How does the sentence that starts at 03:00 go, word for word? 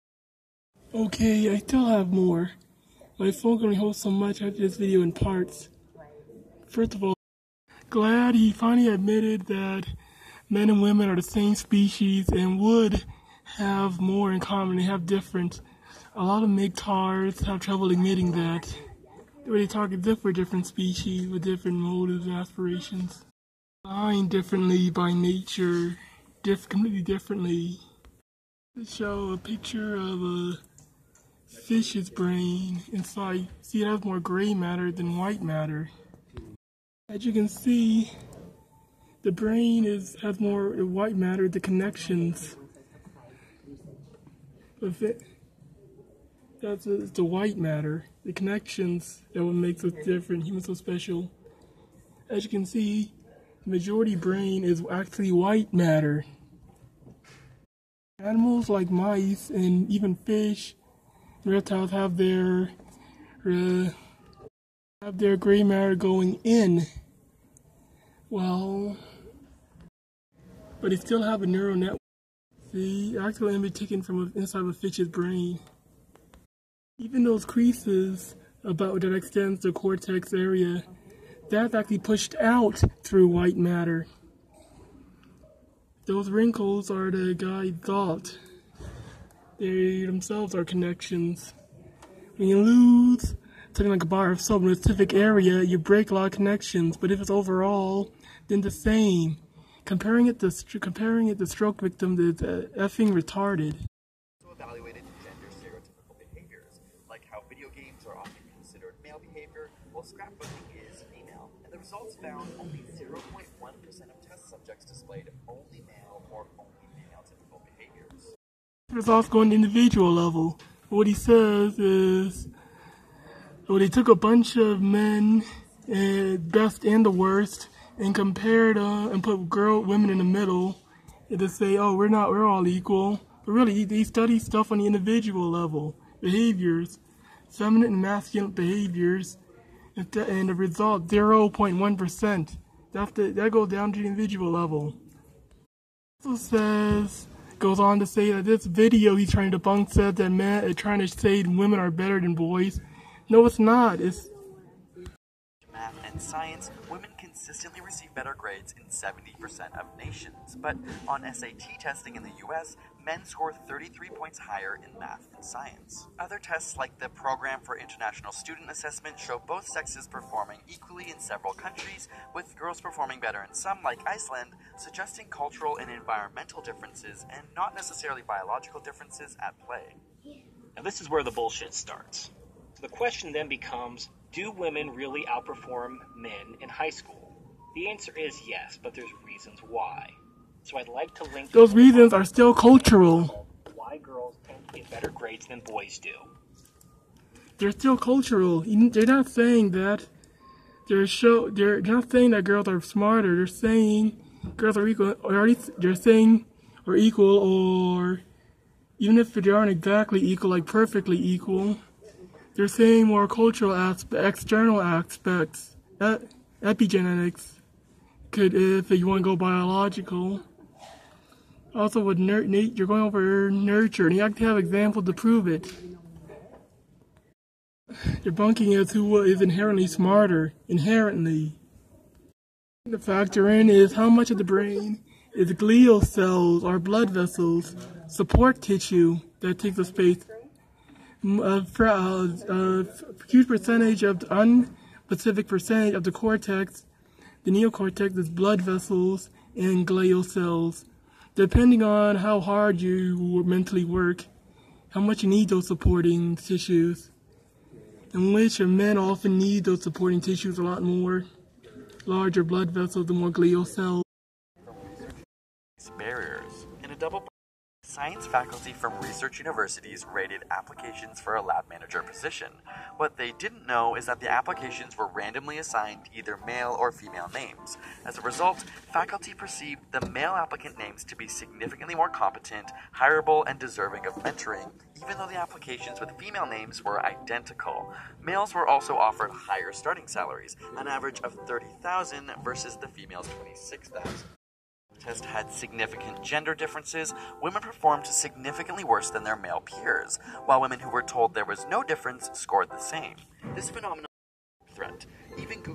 Now, this is where the bullshit starts.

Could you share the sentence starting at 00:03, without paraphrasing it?
My phone can only hold so much after this video in parts.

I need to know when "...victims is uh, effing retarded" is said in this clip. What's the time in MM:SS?
01:41.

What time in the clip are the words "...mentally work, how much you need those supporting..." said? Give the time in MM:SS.
04:13.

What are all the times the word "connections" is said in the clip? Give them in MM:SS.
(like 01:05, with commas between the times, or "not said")
00:41, 00:48, 01:30, 01:36.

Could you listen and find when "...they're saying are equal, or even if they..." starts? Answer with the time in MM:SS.
03:25.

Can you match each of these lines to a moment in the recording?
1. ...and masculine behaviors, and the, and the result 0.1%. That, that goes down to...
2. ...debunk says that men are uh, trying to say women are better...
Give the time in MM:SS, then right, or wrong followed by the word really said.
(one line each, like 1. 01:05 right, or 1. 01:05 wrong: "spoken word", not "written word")
1. 02:17 right
2. 02:29 right.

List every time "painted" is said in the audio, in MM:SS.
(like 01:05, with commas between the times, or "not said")
not said.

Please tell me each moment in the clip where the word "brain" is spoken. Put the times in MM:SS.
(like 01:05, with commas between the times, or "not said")
00:32, 00:39, 00:54, 01:15, 03:54.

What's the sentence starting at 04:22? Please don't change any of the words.
Larger blood vessels, the more glial cells.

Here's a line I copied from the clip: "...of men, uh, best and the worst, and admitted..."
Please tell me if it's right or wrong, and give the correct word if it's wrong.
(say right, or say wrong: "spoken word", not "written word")
wrong: "compared", not "admitted".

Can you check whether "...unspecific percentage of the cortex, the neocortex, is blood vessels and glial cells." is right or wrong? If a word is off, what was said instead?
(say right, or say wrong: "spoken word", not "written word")
right.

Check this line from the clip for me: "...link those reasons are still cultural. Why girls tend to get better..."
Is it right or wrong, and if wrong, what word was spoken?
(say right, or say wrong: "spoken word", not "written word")
right.